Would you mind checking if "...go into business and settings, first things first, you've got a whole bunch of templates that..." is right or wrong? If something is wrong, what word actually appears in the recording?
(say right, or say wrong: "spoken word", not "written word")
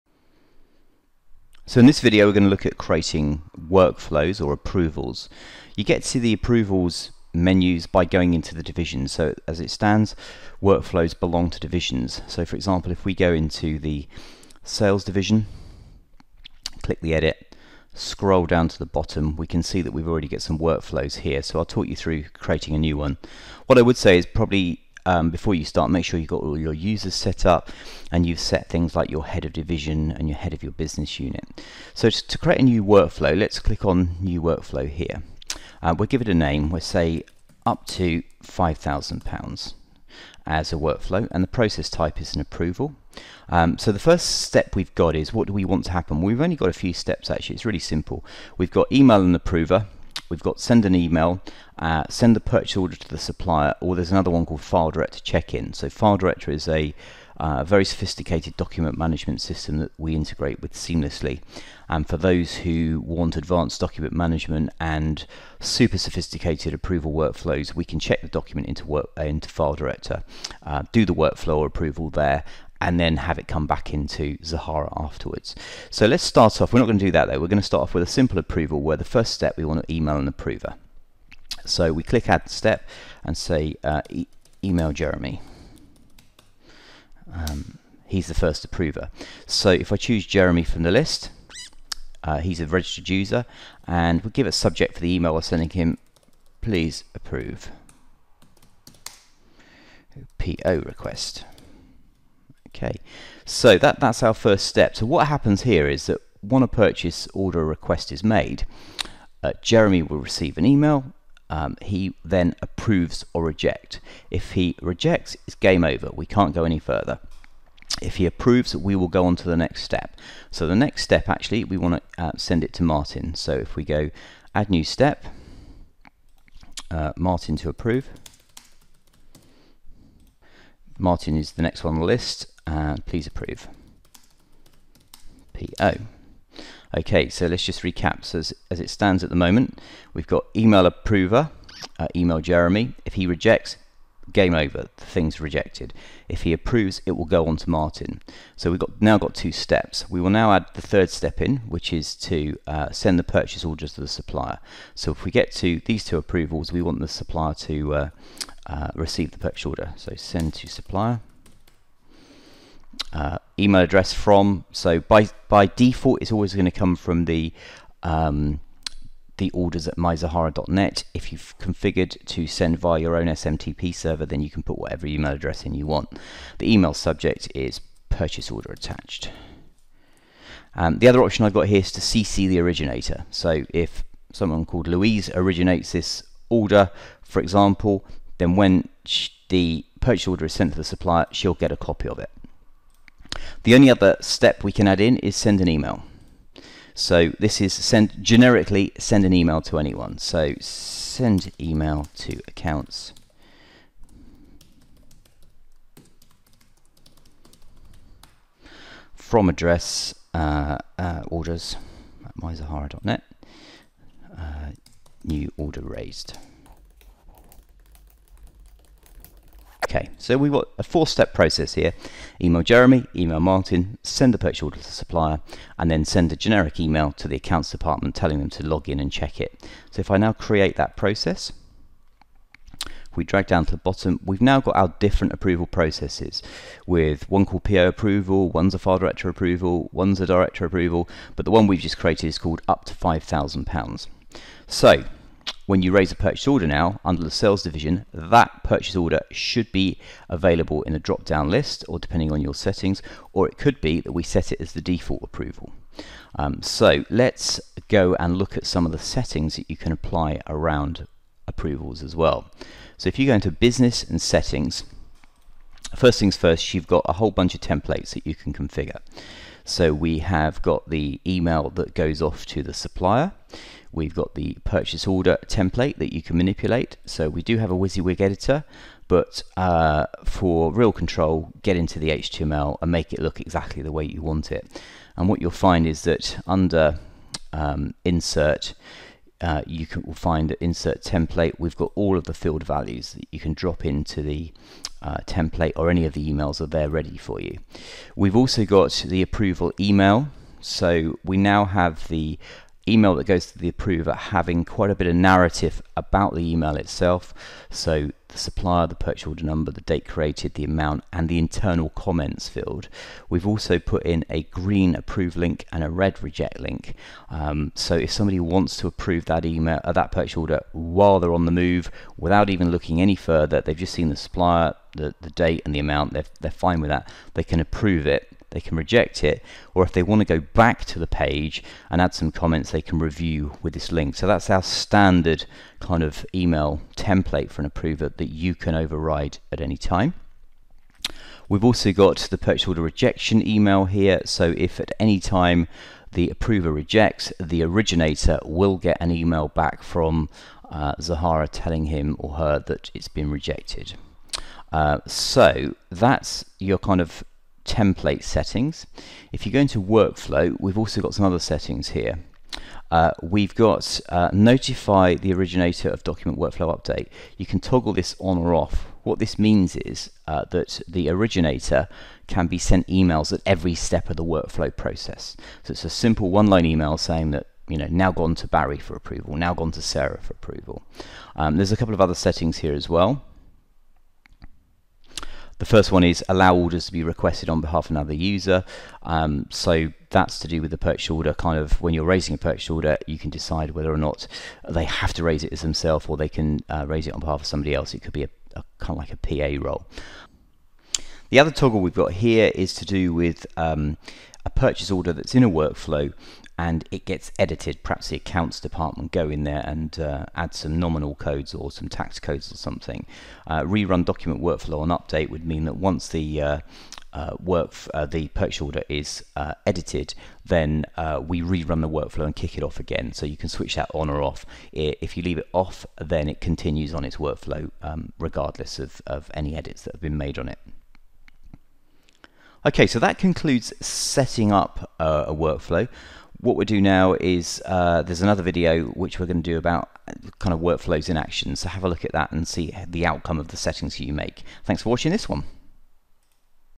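right.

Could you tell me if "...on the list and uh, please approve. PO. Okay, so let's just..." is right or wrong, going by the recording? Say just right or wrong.
right.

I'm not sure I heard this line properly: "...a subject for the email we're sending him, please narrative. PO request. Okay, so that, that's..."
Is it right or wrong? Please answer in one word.
wrong.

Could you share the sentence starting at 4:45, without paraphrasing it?
And what you'll find is that under um, insert, uh, you can will find insert template.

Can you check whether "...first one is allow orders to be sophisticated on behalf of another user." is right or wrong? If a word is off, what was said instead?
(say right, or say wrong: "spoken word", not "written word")
wrong: "requested", not "sophisticated".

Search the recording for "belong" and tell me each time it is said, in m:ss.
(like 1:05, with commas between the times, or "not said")
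0:11.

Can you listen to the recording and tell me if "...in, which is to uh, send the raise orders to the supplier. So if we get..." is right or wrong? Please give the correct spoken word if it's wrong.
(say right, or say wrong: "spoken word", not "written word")
wrong: "purchase", not "raise".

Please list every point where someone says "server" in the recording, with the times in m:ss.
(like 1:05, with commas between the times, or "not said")
2:53.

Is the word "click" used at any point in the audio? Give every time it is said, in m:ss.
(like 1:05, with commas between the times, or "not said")
0:16, 0:33, 1:22.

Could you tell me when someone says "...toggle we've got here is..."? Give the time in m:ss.
6:41.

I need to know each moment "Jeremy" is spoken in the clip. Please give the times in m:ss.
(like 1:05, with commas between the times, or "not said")
1:24, 1:30, 1:49, 2:22, 3:42.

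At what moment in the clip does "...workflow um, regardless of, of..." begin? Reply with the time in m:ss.
7:07.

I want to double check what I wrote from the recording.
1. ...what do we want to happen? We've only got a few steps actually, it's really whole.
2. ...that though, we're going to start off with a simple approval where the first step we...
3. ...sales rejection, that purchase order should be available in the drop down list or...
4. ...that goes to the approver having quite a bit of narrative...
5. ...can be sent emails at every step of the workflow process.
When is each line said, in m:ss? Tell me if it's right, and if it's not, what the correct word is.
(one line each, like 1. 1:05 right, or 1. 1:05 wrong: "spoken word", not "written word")
1. 0:45 wrong: "simple", not "whole"
2. 1:17 right
3. 4:07 wrong: "division", not "rejection"
4. 5:03 right
5. 6:12 right.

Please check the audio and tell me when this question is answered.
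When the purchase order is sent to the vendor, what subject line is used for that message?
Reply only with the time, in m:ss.
2:58.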